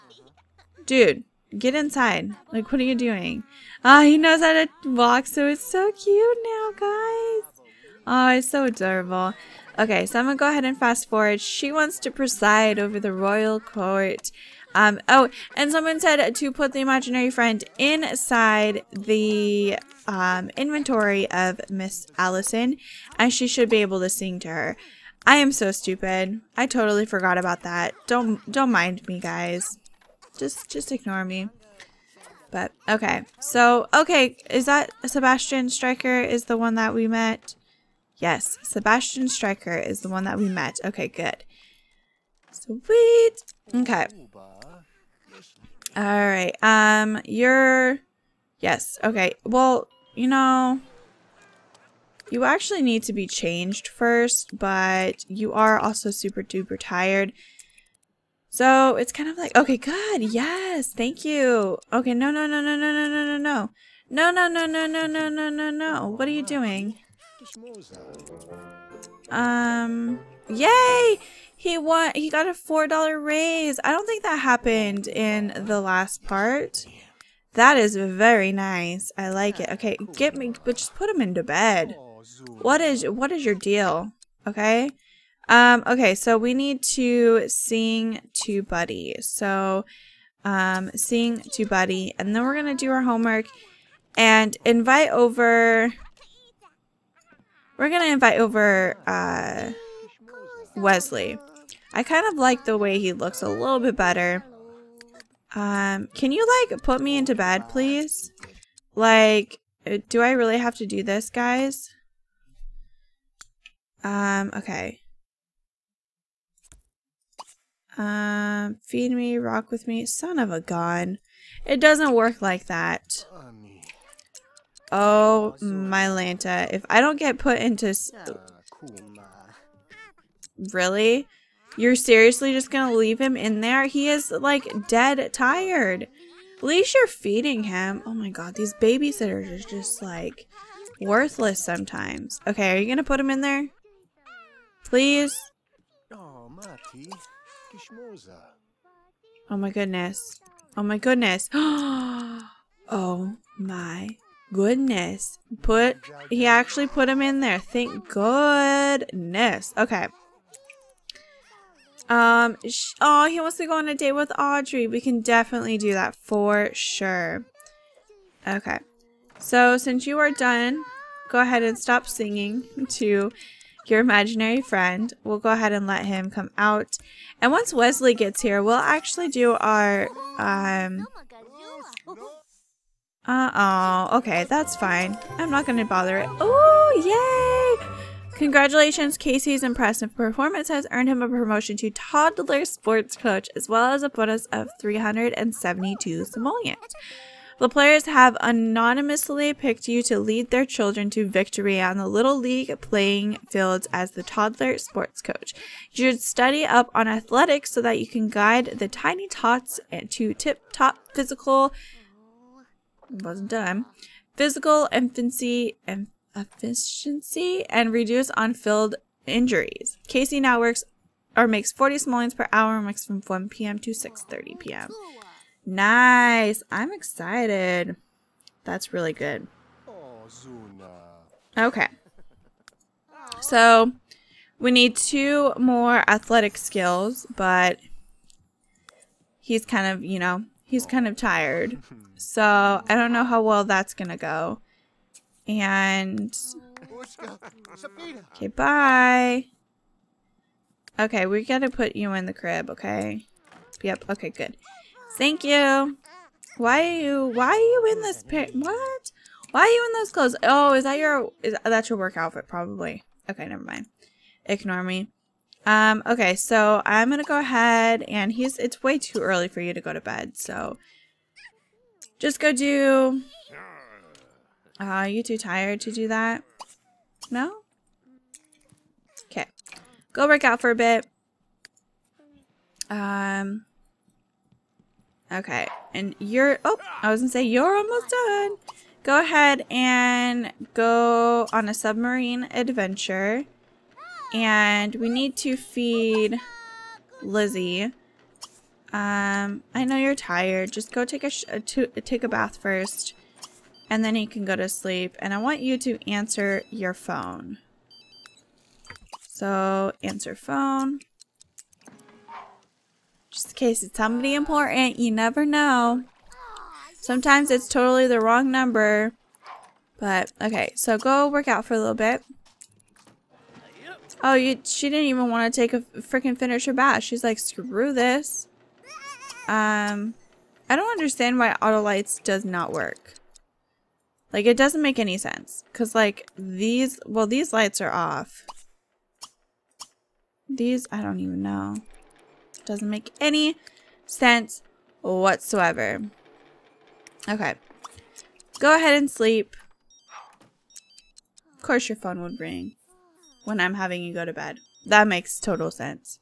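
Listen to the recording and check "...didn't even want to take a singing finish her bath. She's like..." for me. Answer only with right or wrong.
wrong.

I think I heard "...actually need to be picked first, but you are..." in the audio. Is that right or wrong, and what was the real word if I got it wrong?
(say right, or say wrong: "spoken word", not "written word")
wrong: "changed", not "picked".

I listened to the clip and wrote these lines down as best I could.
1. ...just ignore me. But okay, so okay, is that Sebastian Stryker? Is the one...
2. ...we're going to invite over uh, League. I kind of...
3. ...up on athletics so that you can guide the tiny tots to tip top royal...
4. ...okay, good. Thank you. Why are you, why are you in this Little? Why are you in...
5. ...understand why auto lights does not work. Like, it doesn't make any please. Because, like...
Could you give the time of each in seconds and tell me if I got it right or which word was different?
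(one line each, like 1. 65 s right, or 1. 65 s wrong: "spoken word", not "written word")
1. 30 s right
2. 97 s wrong: "Wesley", not "League"
3. 206 s wrong: "physical", not "royal"
4. 254 s wrong: "What", not "Little"
5. 330 s wrong: "sense", not "please".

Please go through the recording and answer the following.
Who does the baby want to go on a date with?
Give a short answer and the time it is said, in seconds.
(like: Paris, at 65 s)
Audrey, at 164 s.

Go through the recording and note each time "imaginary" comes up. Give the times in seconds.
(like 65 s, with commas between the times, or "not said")
16 s, 173 s.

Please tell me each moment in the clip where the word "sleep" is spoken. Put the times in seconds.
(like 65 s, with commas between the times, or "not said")
304 s, 349 s.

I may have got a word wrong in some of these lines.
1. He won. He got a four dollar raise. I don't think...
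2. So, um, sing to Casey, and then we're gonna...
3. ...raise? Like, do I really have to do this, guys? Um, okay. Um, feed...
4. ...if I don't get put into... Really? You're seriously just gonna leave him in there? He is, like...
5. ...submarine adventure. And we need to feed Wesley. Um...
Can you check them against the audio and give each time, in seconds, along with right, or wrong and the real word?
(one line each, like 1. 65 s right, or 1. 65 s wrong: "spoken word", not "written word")
1. 71 s right
2. 89 s wrong: "Buddy", not "Casey"
3. 107 s wrong: "please", not "raise"
4. 126 s right
5. 291 s wrong: "Lizzie", not "Wesley".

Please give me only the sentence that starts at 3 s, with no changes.
Ah, he knows how to walk, so it's so cute now, guys.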